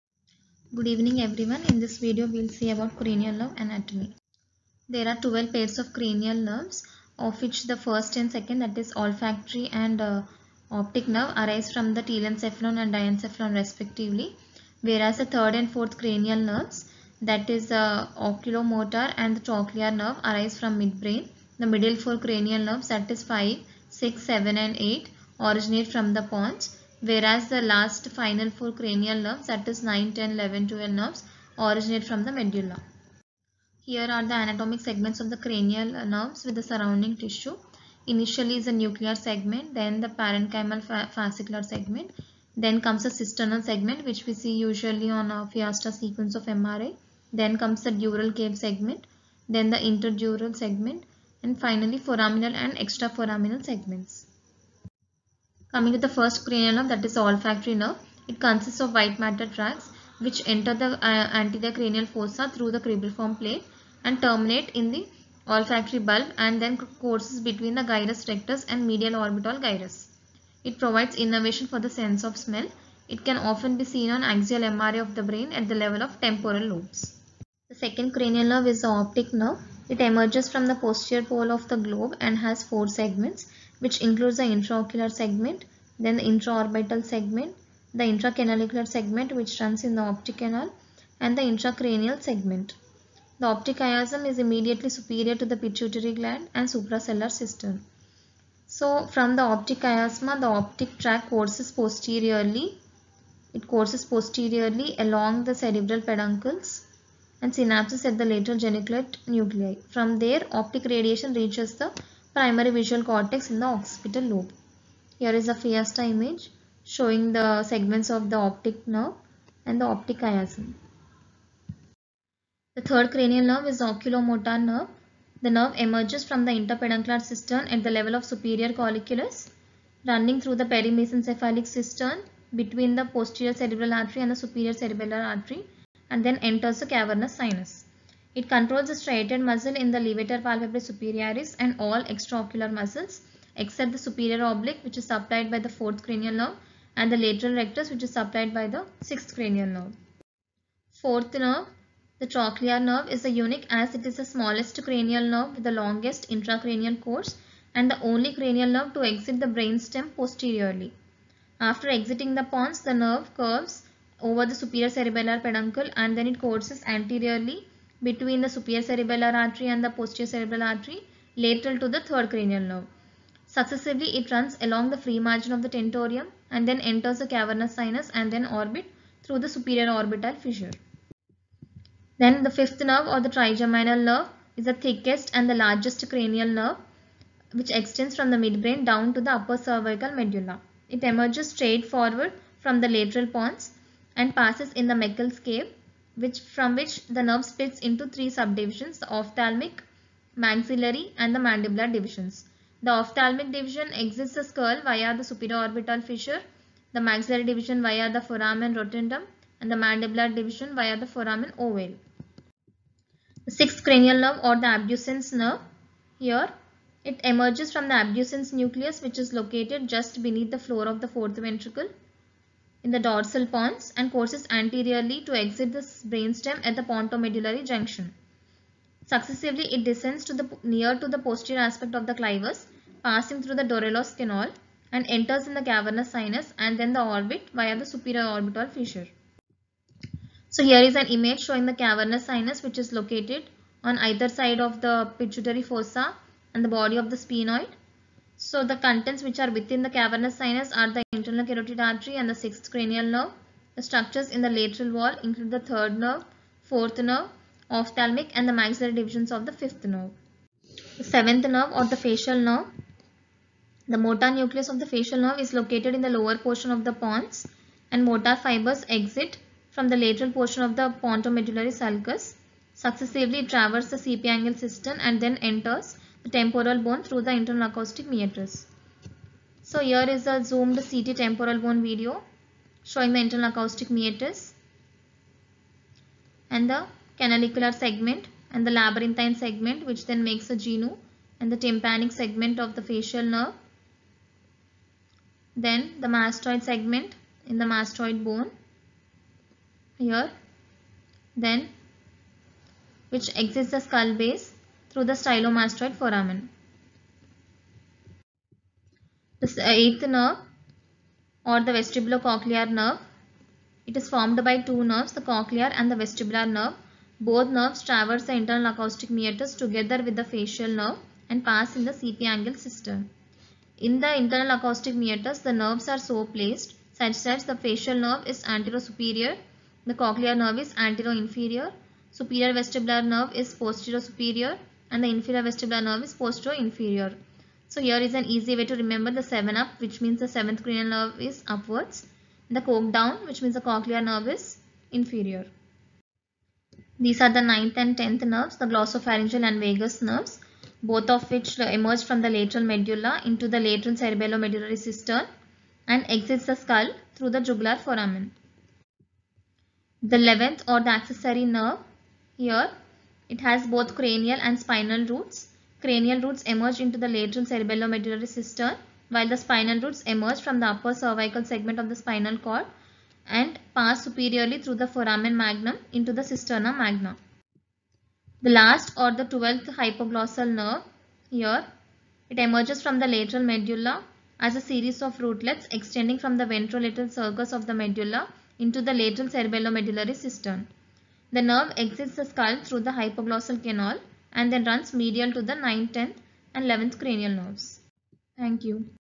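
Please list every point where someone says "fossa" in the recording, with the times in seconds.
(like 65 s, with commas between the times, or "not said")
62 s, 245 s.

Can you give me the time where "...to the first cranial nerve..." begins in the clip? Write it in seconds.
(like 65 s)
55 s.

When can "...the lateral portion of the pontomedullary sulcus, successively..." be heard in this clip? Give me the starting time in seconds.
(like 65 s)
269 s.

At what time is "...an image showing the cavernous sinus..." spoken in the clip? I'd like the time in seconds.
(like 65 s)
240 s.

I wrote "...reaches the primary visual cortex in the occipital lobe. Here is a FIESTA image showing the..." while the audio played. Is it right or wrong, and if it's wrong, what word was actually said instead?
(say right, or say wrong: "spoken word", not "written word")
right.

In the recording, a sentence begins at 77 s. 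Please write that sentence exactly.
The second cranial nerve is the optic nerve.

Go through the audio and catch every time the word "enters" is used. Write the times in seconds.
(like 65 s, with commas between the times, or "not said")
60 s, 136 s, 176 s, 235 s, 275 s.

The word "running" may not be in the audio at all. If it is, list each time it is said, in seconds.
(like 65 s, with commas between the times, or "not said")
130 s.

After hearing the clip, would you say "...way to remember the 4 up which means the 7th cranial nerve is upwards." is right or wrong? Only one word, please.
wrong.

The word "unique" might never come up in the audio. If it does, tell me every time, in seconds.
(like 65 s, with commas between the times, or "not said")
153 s.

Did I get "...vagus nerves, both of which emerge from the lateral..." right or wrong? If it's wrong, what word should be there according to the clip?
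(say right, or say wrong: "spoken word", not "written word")
right.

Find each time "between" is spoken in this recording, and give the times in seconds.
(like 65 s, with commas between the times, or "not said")
67 s, 132 s, 168 s.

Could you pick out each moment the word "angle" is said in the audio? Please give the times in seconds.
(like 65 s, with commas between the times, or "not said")
274 s, 322 s.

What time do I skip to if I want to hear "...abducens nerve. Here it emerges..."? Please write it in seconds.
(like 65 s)
214 s.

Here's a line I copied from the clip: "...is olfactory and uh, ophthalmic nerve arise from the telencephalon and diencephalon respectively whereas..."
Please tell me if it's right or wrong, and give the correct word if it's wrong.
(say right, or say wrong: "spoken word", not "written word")
wrong: "optic", not "ophthalmic".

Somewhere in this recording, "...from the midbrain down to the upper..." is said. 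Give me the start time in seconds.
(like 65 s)
188 s.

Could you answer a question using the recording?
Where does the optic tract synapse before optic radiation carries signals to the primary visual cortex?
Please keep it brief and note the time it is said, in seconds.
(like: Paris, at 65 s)
Lateral geniculate nuclei, at 108 s.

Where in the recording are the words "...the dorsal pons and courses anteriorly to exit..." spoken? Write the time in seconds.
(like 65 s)
222 s.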